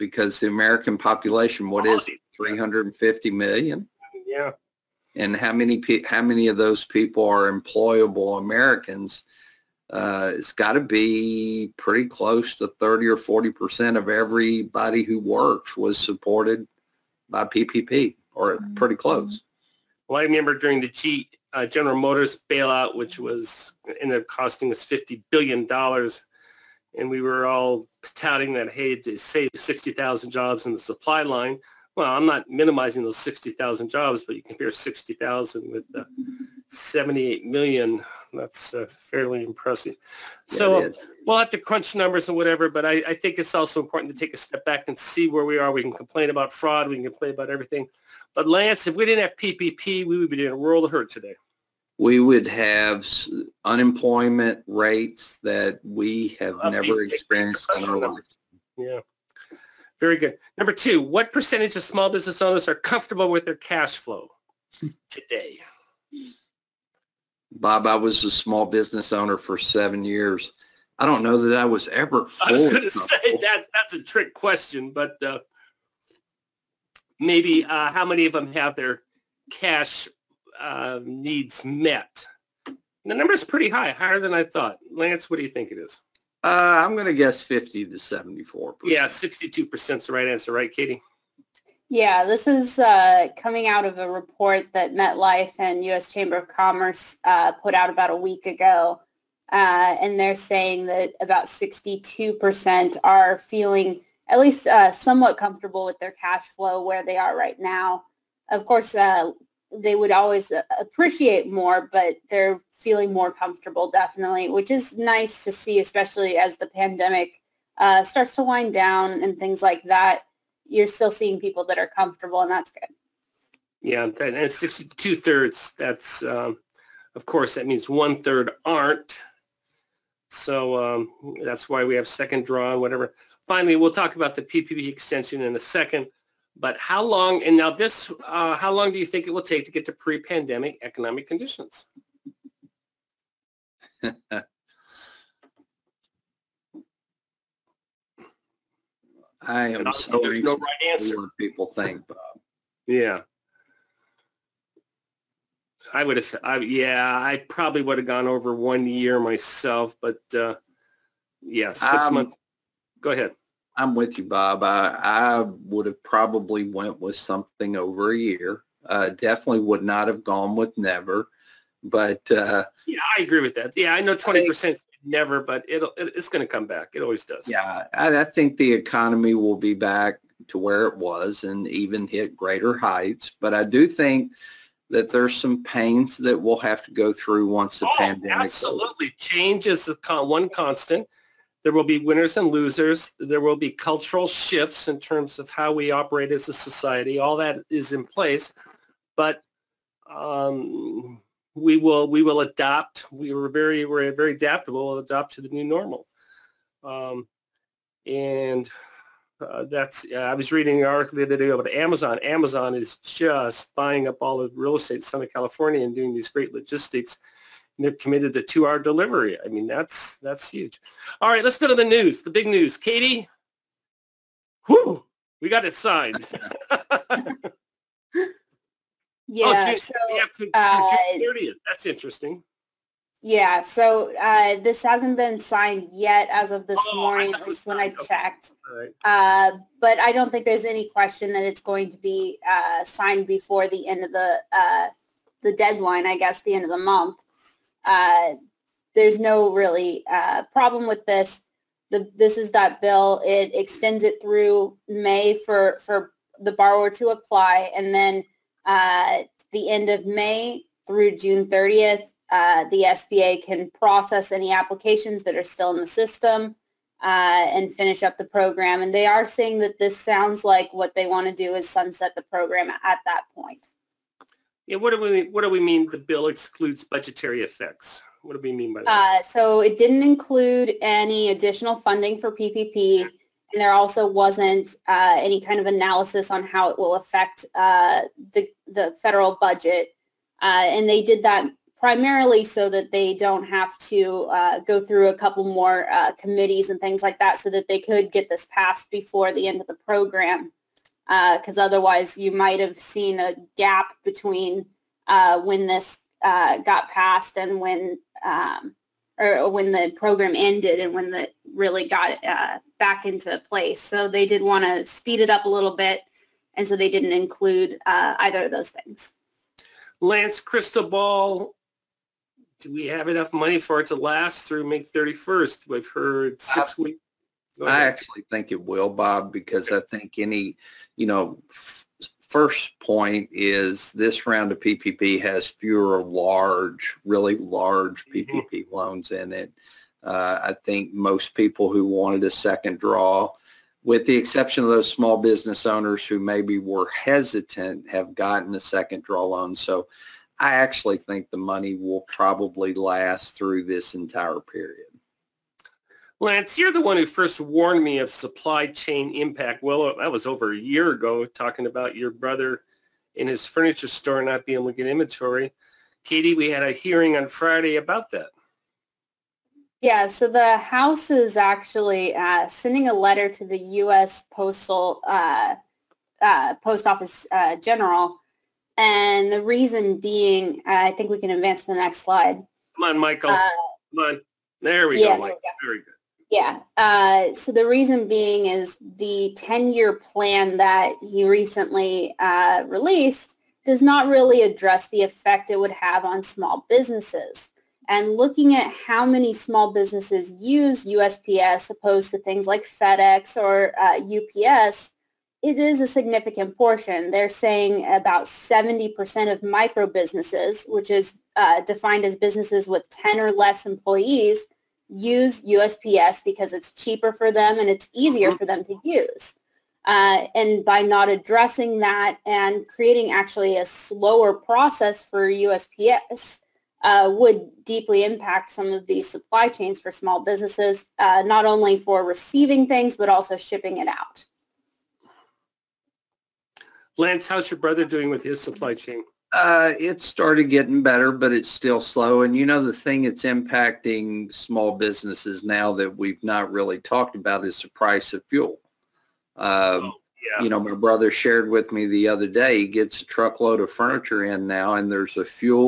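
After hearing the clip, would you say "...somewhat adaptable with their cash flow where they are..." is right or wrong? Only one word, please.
wrong.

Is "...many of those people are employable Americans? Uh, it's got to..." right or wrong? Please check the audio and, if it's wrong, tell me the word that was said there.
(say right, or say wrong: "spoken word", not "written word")
right.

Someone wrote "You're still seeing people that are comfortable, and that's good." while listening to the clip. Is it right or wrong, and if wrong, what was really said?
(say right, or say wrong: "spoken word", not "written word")
right.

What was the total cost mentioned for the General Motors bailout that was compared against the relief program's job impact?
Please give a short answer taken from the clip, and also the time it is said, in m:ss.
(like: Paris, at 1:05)
$50 billion, at 0:24.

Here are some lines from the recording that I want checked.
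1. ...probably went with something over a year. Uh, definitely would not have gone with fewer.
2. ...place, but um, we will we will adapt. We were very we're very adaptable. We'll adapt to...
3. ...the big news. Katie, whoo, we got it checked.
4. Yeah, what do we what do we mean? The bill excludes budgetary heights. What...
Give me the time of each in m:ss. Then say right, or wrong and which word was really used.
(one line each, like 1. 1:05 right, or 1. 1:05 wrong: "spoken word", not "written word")
1. 2:46 wrong: "never", not "fewer"
2. 3:18 right
3. 3:42 wrong: "signed", not "checked"
4. 4:34 wrong: "effects", not "heights".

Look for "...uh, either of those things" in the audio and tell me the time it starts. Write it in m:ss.
5:17.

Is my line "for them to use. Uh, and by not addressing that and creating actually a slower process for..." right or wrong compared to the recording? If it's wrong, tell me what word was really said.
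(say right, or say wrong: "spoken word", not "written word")
right.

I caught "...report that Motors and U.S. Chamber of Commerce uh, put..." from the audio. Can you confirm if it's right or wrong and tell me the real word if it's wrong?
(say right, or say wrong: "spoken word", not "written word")
wrong: "MetLife", not "Motors".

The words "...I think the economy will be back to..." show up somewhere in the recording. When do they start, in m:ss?
2:58.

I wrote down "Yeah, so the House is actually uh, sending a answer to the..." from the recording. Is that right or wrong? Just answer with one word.
wrong.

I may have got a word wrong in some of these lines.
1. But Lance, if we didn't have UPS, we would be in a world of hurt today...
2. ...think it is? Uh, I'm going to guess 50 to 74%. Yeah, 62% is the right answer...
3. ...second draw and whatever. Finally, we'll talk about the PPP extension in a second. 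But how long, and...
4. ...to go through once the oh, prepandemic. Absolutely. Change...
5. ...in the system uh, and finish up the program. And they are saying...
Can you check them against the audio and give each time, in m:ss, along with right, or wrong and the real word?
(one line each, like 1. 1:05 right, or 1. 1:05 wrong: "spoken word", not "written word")
1. 0:48 wrong: "PPP", not "UPS"
2. 1:25 right
3. 2:12 right
4. 3:06 wrong: "pandemic", not "prepandemic"
5. 4:25 right.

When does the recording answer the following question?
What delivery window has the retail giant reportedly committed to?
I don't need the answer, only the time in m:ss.
3:38.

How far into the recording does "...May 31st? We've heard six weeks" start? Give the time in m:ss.
5:24.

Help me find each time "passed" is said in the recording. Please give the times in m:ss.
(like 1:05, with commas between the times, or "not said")
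4:58, 5:06.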